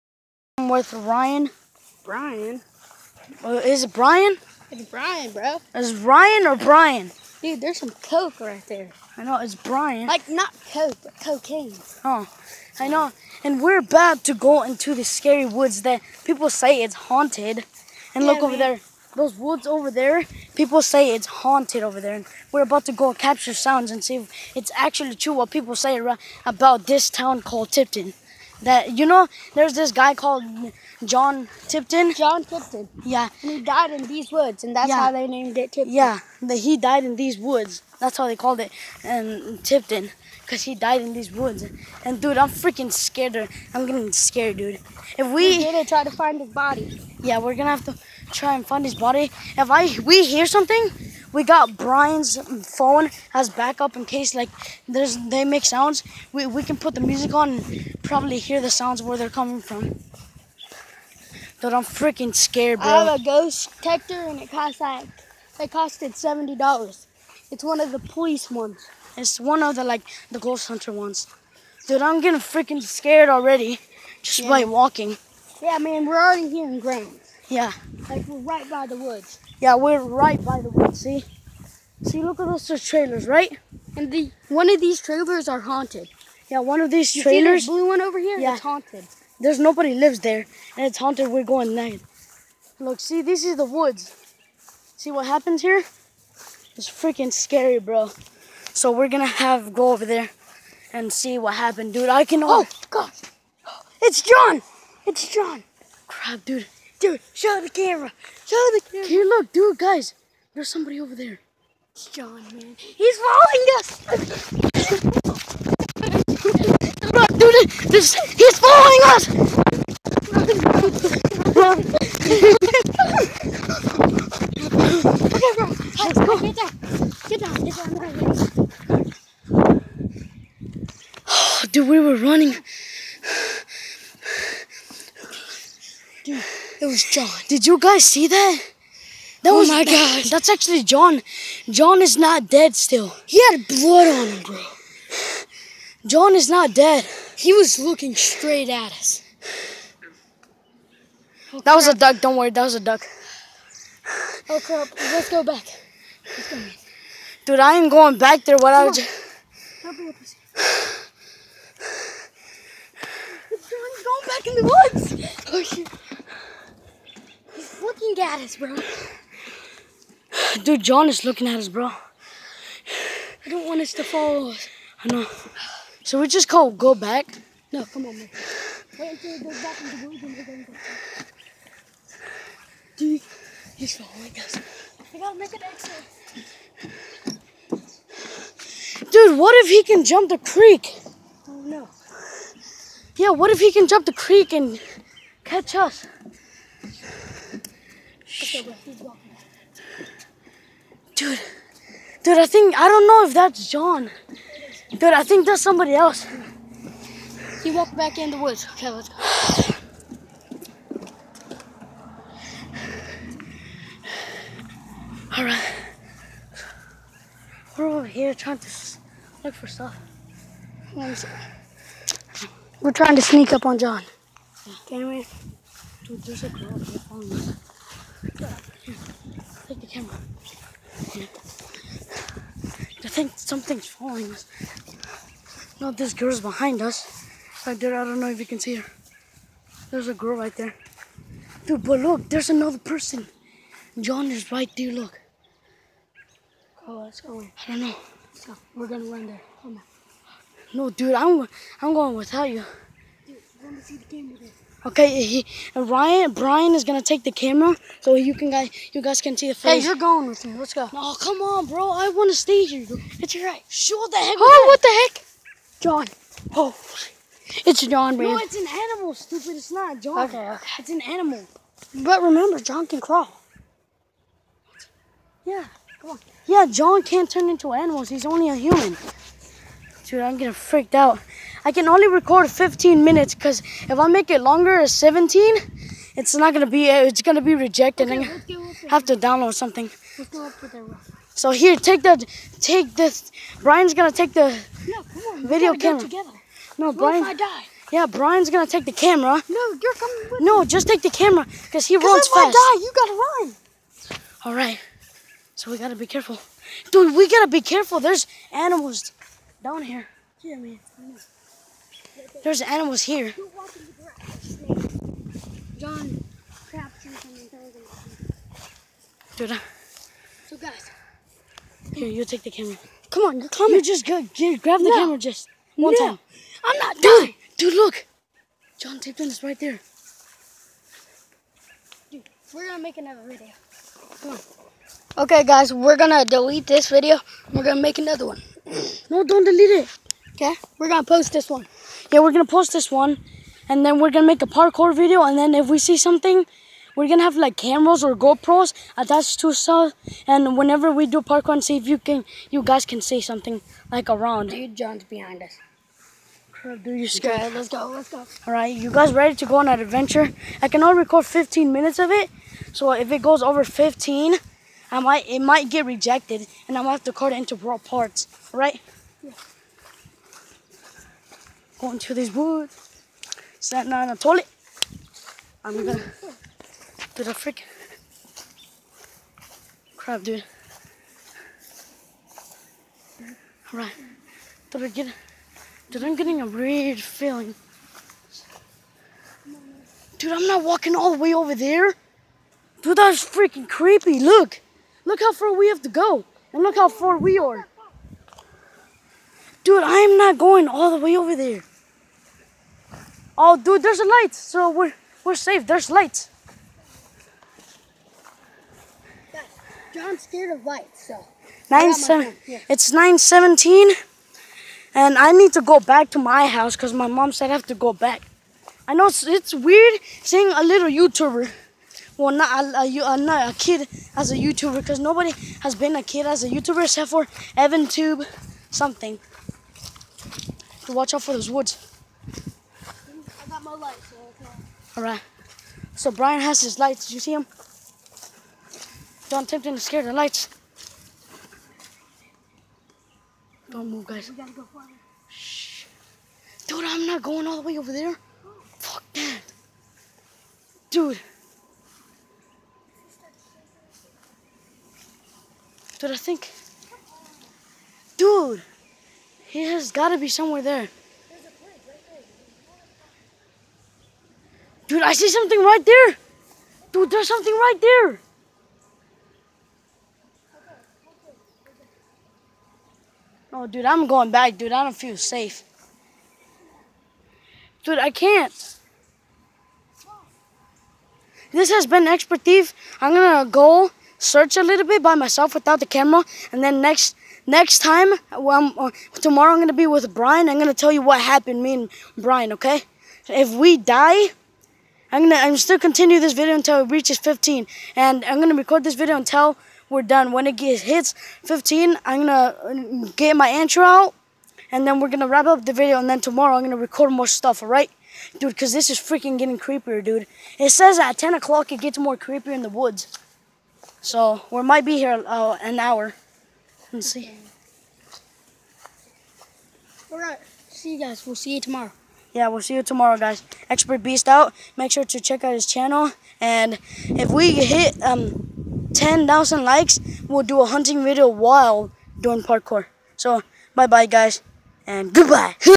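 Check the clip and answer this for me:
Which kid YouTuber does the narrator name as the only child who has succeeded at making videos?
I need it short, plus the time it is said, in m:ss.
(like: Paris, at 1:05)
EvanTube, at 7:07.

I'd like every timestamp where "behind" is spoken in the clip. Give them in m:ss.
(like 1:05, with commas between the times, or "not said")
3:56, 5:55.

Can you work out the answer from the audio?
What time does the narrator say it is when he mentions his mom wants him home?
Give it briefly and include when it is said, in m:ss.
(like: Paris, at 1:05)
9:17, at 6:52.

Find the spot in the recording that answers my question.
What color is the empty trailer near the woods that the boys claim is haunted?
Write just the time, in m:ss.
1:27.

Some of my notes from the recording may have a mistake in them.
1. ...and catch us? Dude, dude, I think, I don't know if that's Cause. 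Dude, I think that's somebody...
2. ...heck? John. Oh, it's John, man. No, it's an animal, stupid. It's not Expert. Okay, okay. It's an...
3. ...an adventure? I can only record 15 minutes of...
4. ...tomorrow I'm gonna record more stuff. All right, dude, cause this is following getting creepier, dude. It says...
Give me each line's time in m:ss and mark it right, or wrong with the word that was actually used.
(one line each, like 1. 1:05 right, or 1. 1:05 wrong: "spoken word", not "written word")
1. 3:14 wrong: "John", not "Cause"
2. 4:25 wrong: "John", not "Expert"
3. 5:59 right
4. 8:26 wrong: "freaking", not "following".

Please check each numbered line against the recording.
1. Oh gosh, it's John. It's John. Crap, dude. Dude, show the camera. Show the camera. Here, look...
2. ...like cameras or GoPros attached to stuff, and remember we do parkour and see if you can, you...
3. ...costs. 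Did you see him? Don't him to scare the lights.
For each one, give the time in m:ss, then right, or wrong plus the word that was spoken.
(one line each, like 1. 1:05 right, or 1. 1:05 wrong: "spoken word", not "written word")
1. 1:42 right
2. 5:47 wrong: "whenever", not "remember"
3. 7:16 wrong: "lights", not "costs".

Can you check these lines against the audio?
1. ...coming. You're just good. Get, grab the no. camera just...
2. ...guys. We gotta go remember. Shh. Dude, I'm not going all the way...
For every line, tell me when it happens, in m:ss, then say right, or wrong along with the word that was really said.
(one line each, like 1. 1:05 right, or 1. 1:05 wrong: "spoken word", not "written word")
1. 5:23 right
2. 7:24 wrong: "farther", not "remember".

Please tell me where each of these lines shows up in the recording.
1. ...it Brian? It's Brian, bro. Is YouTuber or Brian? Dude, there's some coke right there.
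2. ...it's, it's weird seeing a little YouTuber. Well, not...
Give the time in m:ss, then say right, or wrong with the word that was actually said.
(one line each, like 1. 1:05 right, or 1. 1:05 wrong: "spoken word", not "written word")
1. 0:03 wrong: "Ryan", not "YouTuber"
2. 6:59 right.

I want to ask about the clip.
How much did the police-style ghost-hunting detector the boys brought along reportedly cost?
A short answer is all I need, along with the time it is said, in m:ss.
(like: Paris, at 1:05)
$70, at 1:06.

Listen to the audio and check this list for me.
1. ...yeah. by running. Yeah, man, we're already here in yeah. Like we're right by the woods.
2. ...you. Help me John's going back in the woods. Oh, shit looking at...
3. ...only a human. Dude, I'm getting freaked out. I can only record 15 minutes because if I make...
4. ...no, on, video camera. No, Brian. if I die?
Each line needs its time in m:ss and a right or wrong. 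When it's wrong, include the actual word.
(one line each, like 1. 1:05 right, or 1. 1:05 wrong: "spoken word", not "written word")
1. 1:14 wrong: "walking", not "running"
2. 2:38 right
3. 4:38 right
4. 4:54 right.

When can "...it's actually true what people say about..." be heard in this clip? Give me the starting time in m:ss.
0:24.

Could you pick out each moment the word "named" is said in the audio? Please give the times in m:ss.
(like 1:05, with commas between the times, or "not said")
0:35.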